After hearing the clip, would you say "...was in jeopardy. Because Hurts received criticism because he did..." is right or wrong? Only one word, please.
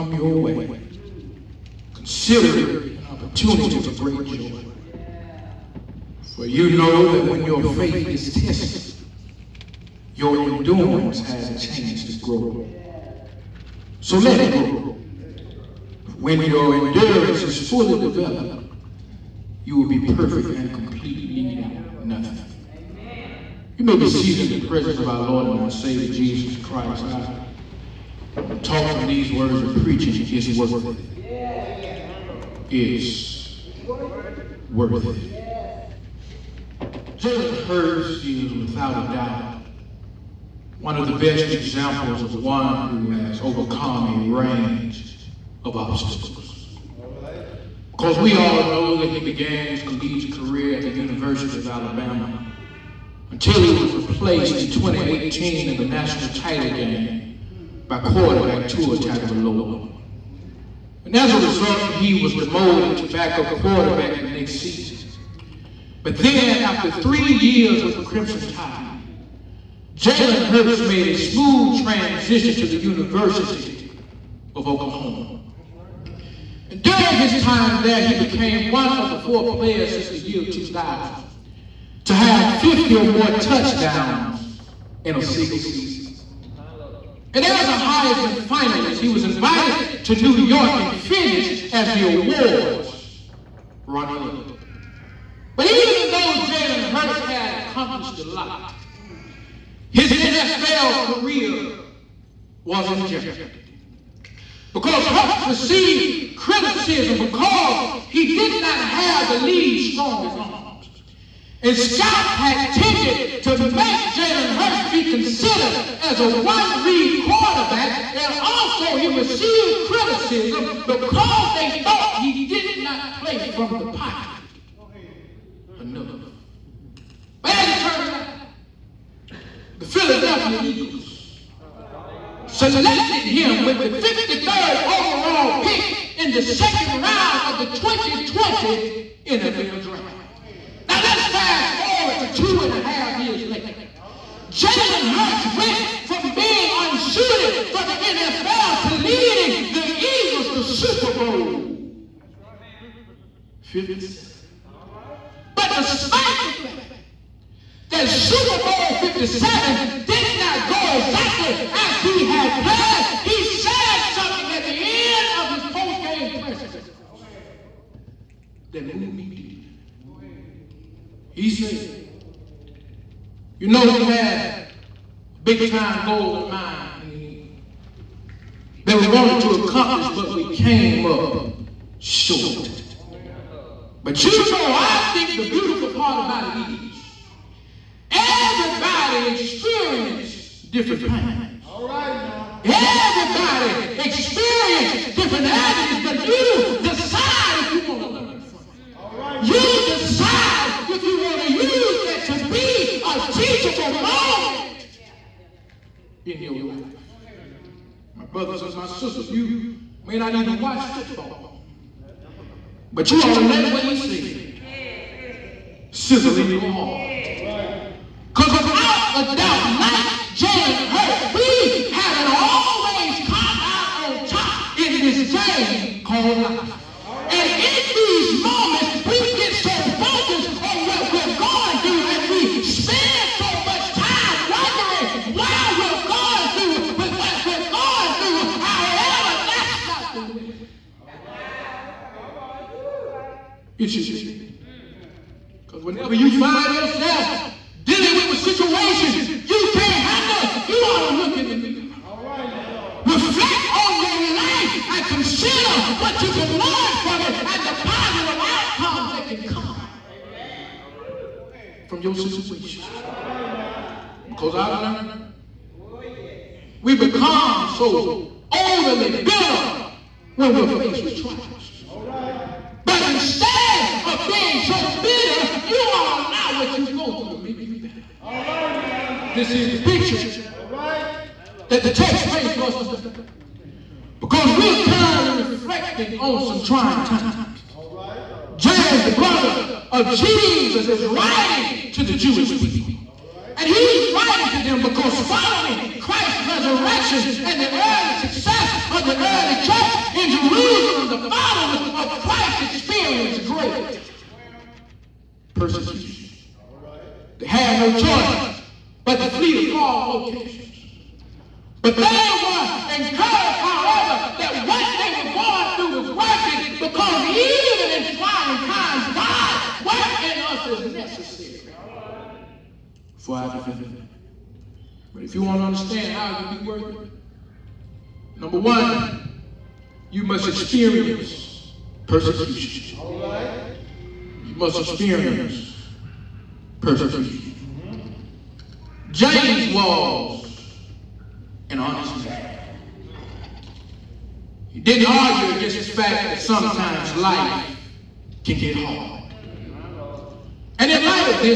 right.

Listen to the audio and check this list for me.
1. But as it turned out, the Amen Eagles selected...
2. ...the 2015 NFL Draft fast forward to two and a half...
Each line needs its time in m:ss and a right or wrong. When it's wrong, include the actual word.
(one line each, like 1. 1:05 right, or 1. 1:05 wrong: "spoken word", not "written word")
1. 2:07 wrong: "Philadelphia", not "Amen"
2. 2:17 wrong: "2020", not "2015".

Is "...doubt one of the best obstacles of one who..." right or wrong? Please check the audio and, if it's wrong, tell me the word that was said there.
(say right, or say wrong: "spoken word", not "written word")
wrong: "examples", not "obstacles".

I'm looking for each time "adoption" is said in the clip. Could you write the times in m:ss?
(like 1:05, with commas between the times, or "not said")
not said.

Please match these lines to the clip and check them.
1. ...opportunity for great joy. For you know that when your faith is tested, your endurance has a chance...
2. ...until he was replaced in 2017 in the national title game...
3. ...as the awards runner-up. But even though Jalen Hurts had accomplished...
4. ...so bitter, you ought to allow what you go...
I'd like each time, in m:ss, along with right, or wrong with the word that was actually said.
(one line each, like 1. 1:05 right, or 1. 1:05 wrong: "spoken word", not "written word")
1. 0:03 right
2. 0:53 wrong: "2018", not "2017"
3. 1:31 right
4. 4:34 right.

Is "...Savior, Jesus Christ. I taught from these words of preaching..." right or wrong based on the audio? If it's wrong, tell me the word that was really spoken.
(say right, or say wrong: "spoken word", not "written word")
right.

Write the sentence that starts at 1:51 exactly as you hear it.
And scouts had tended to make Jalen Hurts be considered as a one read quarterback.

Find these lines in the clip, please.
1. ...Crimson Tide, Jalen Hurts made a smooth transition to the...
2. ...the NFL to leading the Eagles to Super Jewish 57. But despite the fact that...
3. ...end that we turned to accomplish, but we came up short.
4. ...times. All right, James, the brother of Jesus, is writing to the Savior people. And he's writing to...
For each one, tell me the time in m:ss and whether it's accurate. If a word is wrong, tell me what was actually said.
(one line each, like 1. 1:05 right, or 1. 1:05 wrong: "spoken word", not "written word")
1. 1:08 right
2. 2:27 wrong: "Bowl", not "Jewish"
3. 2:57 wrong: "wanted", not "turned"
4. 4:47 wrong: "Jewish", not "Savior".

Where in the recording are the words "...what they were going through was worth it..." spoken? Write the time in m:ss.
5:14.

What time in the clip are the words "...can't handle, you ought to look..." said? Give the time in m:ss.
4:09.